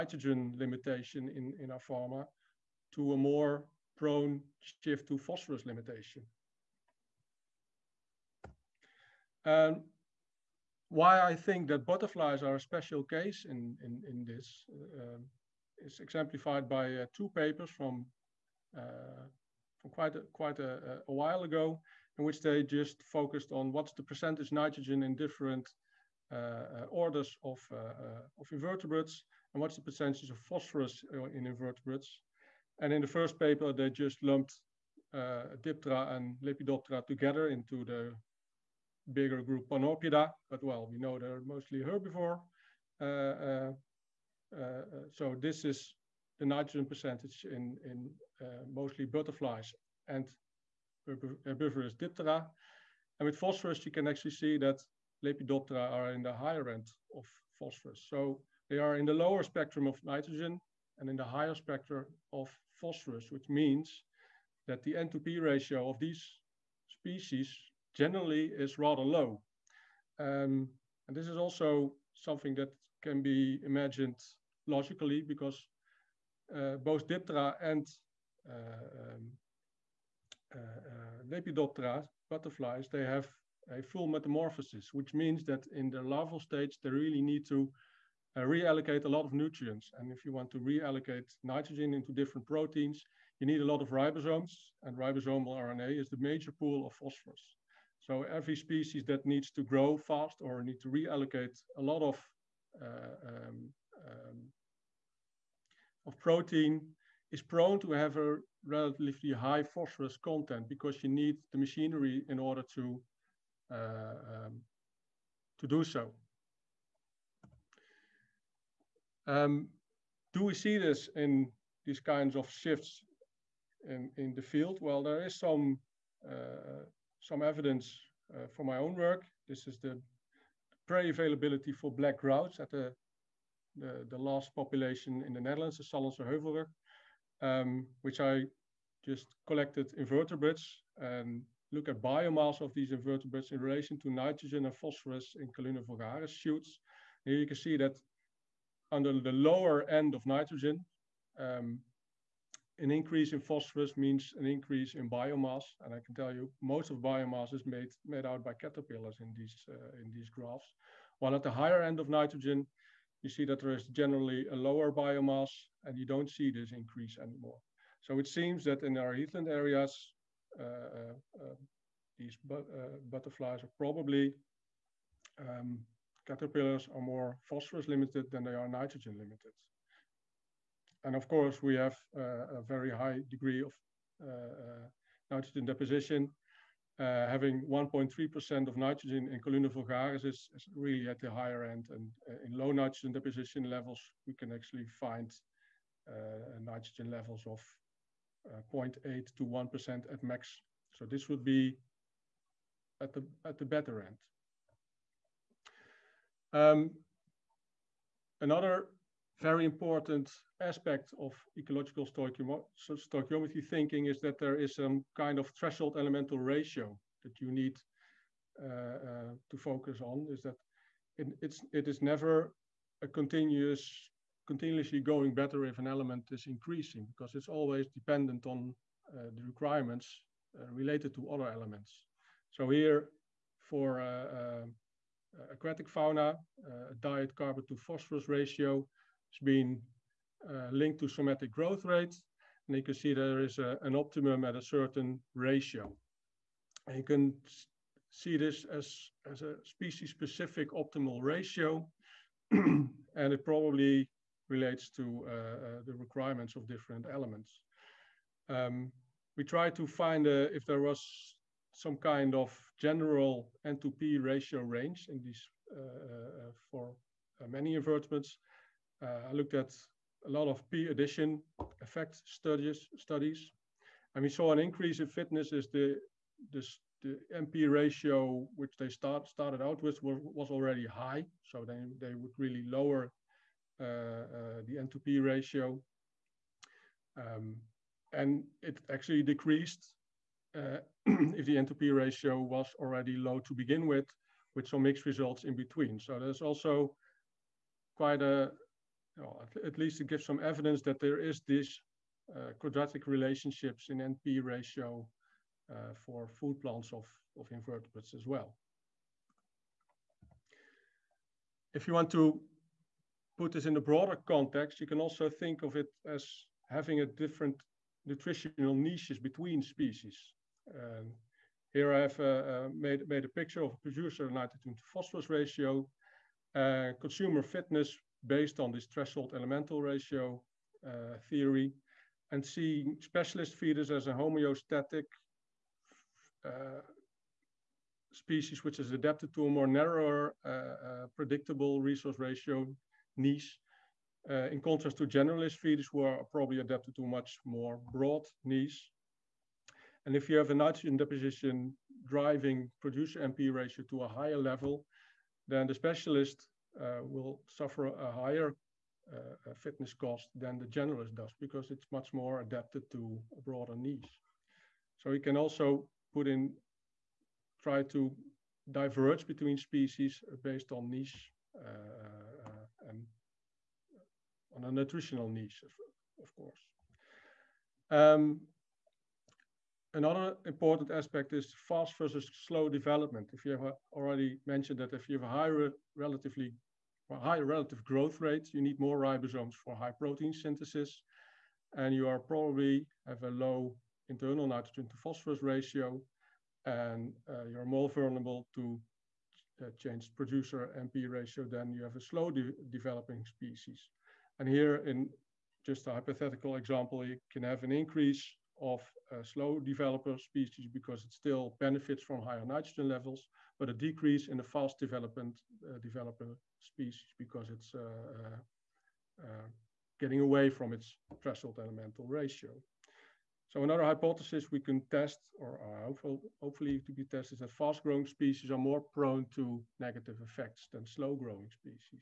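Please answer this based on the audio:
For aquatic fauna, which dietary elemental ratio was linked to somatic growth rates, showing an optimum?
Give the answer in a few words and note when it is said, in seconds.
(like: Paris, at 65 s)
Carbon to phosphorus ratio, at 237 s.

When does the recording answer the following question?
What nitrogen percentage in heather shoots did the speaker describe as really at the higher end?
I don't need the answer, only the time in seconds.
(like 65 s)
187 s.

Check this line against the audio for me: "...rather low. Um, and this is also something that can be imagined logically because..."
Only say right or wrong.
right.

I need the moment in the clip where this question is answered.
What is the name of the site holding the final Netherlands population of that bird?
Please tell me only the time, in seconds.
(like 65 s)
135 s.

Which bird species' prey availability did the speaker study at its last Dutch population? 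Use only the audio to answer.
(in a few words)
Black grouse.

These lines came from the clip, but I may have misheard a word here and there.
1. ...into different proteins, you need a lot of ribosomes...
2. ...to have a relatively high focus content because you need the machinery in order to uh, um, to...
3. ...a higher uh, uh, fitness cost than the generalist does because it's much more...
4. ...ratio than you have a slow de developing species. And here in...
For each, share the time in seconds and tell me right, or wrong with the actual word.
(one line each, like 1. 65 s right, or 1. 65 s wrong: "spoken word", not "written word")
1. 91 s right
2. 107 s wrong: "phosphorus", not "focus"
3. 357 s right
4. 401 s right.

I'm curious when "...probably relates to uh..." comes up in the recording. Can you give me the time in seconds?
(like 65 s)
253 s.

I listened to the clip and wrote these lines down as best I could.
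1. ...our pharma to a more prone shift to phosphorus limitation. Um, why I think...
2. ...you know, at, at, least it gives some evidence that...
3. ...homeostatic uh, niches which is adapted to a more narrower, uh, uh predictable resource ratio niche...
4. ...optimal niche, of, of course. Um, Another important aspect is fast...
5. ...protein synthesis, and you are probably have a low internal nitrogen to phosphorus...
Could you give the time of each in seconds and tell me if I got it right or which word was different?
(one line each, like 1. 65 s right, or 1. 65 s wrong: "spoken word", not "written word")
1. 1 s right
2. 299 s right
3. 334 s wrong: "species", not "niches"
4. 374 s wrong: "nutritional", not "optimal"
5. 389 s right.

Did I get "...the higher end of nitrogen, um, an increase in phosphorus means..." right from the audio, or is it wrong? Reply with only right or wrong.
wrong.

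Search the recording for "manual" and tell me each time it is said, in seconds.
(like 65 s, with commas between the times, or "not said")
not said.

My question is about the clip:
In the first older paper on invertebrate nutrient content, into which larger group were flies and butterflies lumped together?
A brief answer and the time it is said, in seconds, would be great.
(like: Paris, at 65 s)
Panorpida, at 39 s.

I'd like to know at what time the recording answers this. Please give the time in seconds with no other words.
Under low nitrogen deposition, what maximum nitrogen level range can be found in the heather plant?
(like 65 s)
198 s.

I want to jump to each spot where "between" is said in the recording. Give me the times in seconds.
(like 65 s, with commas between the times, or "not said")
295 s, 319 s, 369 s.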